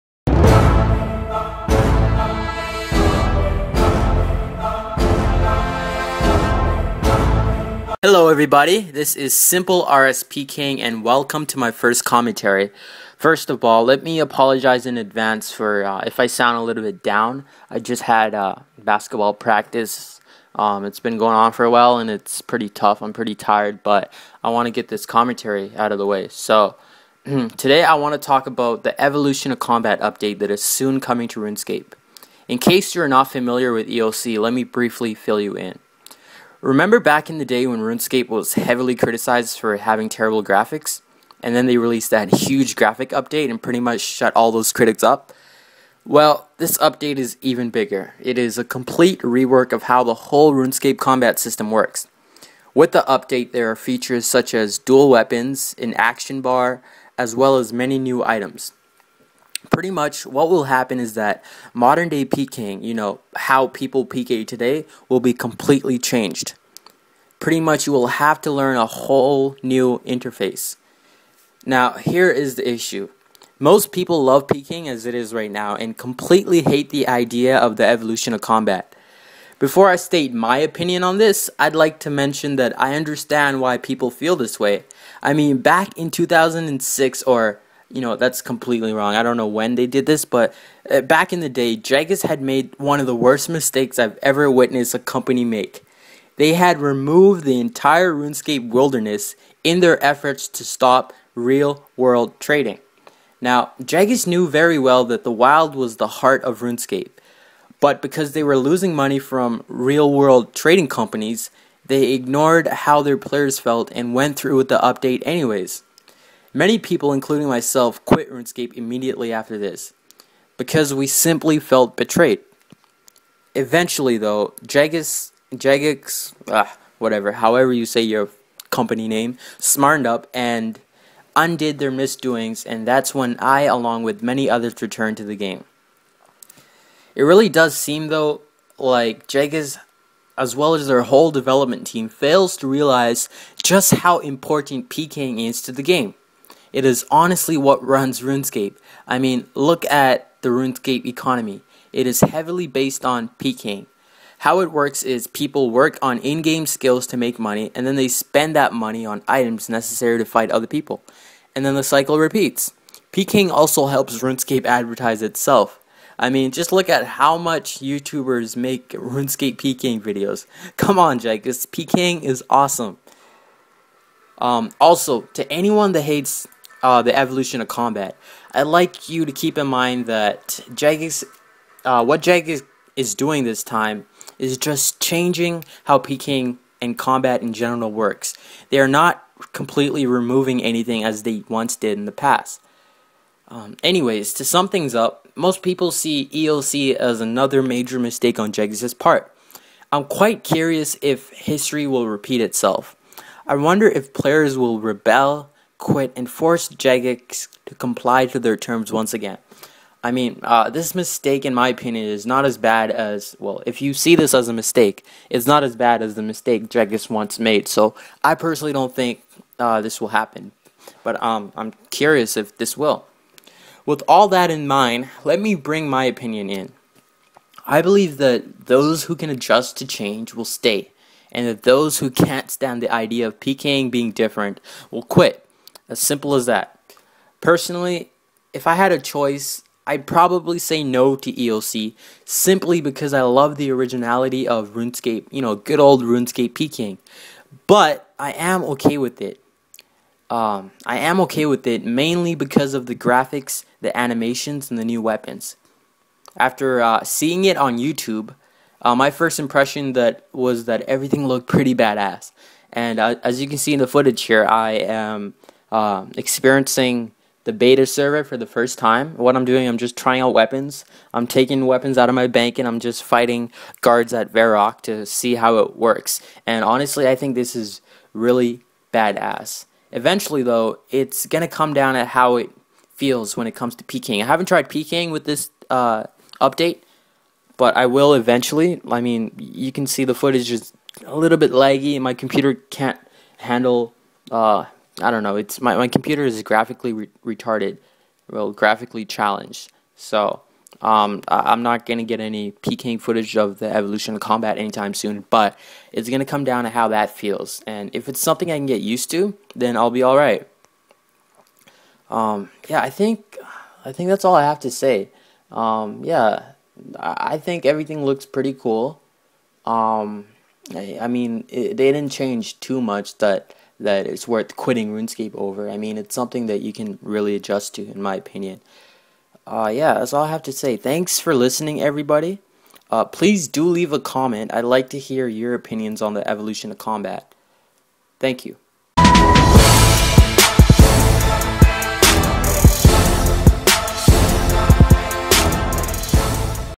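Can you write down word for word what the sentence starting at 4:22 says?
And uh, as you can see in the footage here, I am uh, experiencing the beta server for the first time.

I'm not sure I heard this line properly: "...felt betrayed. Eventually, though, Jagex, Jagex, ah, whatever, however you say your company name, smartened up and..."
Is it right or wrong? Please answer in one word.
right.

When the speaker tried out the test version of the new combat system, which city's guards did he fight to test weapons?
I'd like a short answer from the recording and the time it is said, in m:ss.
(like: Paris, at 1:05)
Varrock, at 4:34.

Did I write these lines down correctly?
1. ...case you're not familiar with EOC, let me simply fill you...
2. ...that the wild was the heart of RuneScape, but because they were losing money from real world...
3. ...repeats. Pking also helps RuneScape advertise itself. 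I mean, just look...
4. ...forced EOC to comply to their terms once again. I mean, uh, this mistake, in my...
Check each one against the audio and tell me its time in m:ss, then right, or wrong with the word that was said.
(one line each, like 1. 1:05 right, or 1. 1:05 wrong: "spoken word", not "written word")
1. 0:32 wrong: "briefly", not "simply"
2. 1:45 right
3. 2:42 right
4. 3:26 wrong: "Jagex", not "EOC".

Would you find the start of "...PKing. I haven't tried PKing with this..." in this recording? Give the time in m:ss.
4:43.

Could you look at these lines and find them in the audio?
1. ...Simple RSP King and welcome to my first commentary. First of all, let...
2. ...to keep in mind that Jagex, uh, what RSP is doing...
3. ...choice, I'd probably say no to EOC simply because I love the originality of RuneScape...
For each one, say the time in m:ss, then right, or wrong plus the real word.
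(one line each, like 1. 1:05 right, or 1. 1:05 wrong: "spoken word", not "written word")
1. 0:09 right
2. 2:59 wrong: "Jagex", not "RSP"
3. 3:58 right.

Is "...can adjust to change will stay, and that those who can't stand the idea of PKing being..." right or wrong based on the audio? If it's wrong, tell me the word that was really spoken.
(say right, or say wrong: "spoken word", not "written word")
right.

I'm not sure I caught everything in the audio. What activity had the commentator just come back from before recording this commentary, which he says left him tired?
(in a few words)
Basketball practice.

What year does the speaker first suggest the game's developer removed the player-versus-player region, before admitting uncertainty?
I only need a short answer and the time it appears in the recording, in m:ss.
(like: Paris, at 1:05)
2006, at 1:26.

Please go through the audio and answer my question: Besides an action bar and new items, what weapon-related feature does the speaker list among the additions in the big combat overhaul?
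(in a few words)
Dual weapons.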